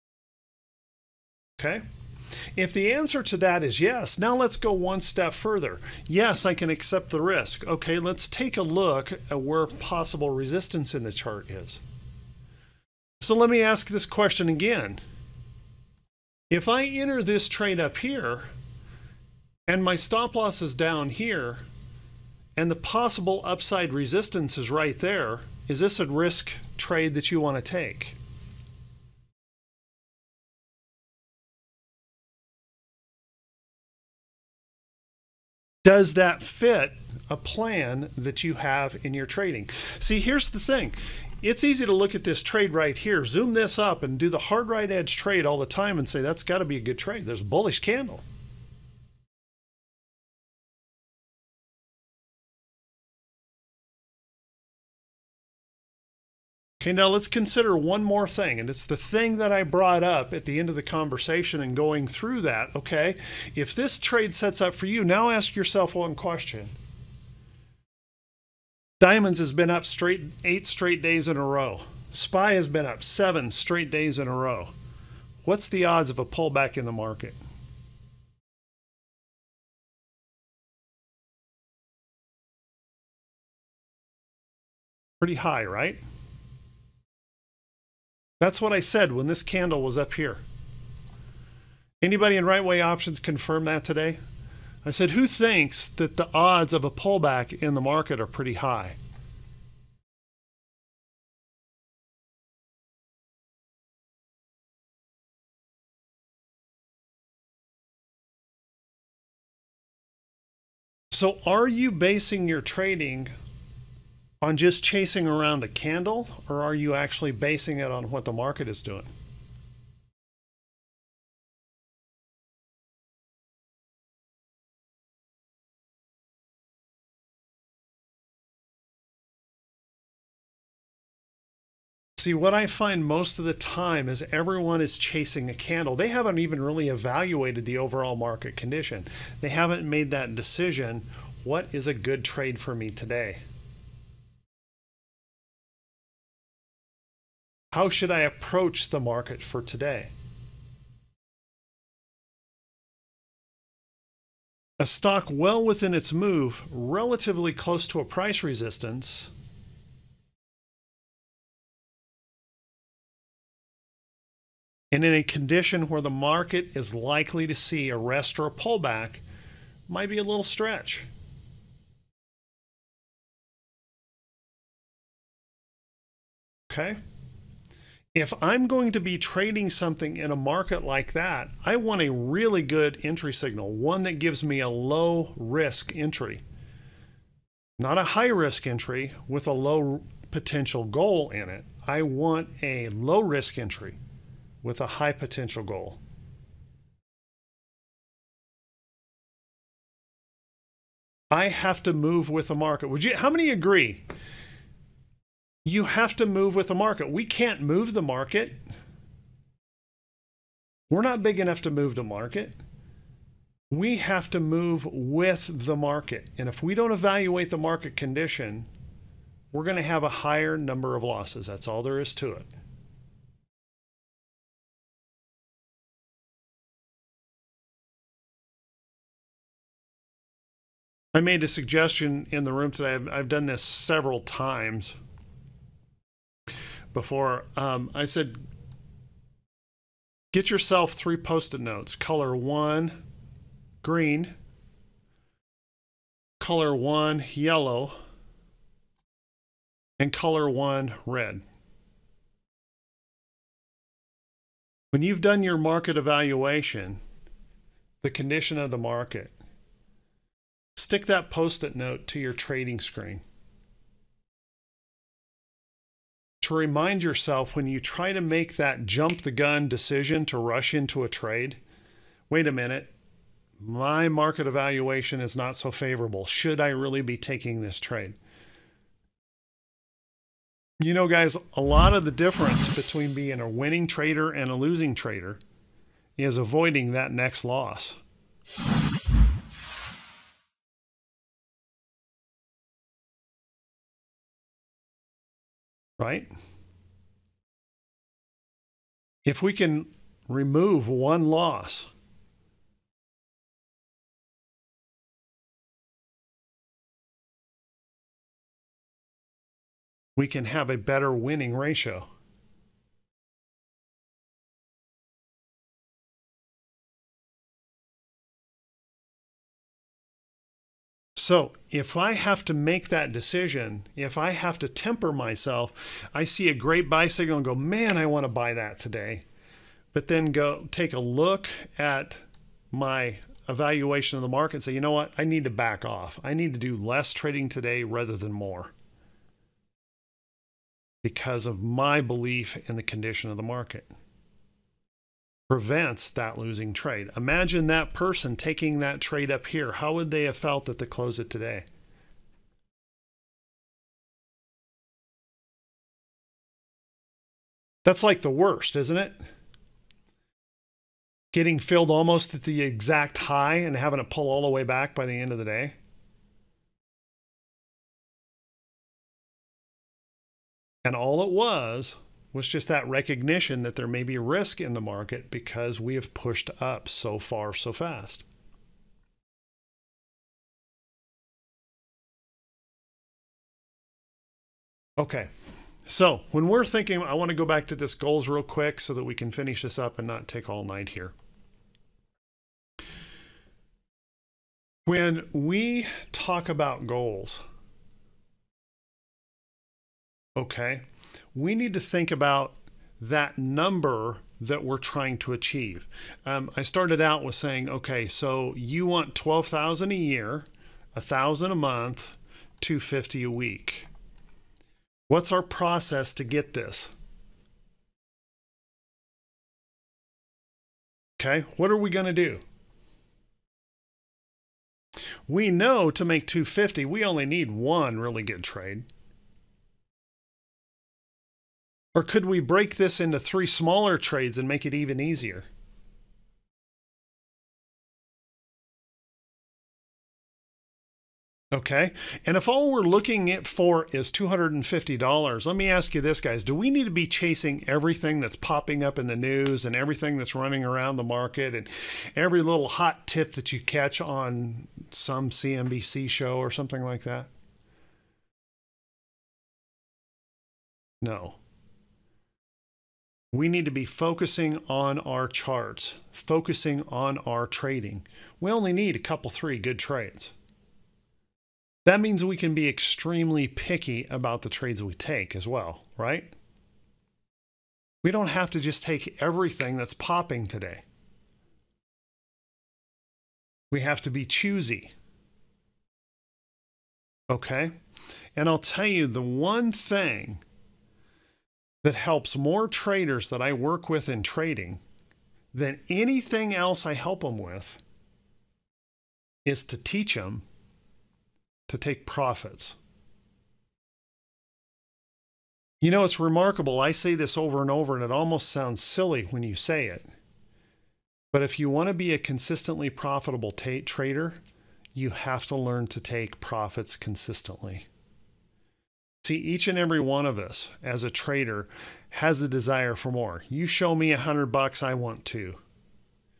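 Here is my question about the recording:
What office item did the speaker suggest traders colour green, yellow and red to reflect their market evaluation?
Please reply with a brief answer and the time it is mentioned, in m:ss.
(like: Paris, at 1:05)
post-it notes, at 4:01.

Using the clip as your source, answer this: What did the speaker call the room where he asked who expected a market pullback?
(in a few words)
right way options.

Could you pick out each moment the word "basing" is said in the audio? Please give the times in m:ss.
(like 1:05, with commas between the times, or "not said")
1:51, 1:57.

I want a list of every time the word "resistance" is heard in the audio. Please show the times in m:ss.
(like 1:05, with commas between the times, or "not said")
0:10, 0:23, 2:38.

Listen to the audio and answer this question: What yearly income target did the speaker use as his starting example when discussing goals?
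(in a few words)
12,000.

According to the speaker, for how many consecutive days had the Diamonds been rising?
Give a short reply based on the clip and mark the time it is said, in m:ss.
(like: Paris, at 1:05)
8, at 1:10.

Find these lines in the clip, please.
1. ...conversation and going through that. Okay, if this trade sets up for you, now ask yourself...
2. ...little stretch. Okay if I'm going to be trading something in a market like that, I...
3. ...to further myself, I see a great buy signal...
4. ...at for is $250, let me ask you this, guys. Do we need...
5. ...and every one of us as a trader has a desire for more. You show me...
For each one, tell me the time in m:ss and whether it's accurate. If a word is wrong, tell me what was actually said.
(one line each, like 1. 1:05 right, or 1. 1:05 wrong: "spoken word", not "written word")
1. 1:00 right
2. 2:50 right
3. 5:24 wrong: "temper", not "further"
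4. 7:23 right
5. 8:39 right.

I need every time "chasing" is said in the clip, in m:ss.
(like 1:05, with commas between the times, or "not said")
1:54, 2:14, 7:27.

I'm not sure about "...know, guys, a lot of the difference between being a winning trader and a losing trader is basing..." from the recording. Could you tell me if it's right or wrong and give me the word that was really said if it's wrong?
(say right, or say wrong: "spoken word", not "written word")
wrong: "avoiding", not "basing".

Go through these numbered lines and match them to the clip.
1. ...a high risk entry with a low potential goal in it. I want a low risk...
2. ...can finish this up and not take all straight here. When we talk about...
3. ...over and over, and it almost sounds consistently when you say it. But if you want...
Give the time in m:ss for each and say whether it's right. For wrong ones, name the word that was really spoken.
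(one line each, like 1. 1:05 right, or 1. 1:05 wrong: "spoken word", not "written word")
1. 3:07 right
2. 6:29 wrong: "night", not "straight"
3. 8:27 wrong: "silly", not "consistently".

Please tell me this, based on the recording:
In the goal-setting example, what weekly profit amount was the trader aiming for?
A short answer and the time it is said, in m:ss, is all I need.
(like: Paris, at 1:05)
250, at 6:52.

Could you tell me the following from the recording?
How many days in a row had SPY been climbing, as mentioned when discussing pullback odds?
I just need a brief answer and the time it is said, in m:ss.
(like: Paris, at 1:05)
7, at 1:13.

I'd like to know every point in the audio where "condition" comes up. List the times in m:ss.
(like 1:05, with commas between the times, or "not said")
2:18, 2:45, 3:37, 4:18, 5:42.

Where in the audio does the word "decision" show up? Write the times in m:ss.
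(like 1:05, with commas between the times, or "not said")
2:20, 4:29, 5:23.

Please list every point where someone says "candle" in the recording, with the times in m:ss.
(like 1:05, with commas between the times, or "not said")
0:47, 1:29, 1:55, 2:15.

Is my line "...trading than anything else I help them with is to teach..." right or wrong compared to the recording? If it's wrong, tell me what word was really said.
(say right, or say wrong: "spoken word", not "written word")
right.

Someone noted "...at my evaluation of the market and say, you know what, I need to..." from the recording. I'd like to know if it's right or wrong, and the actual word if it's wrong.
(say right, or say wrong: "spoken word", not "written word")
right.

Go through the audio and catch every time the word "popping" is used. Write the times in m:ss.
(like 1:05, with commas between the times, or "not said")
7:28, 7:59.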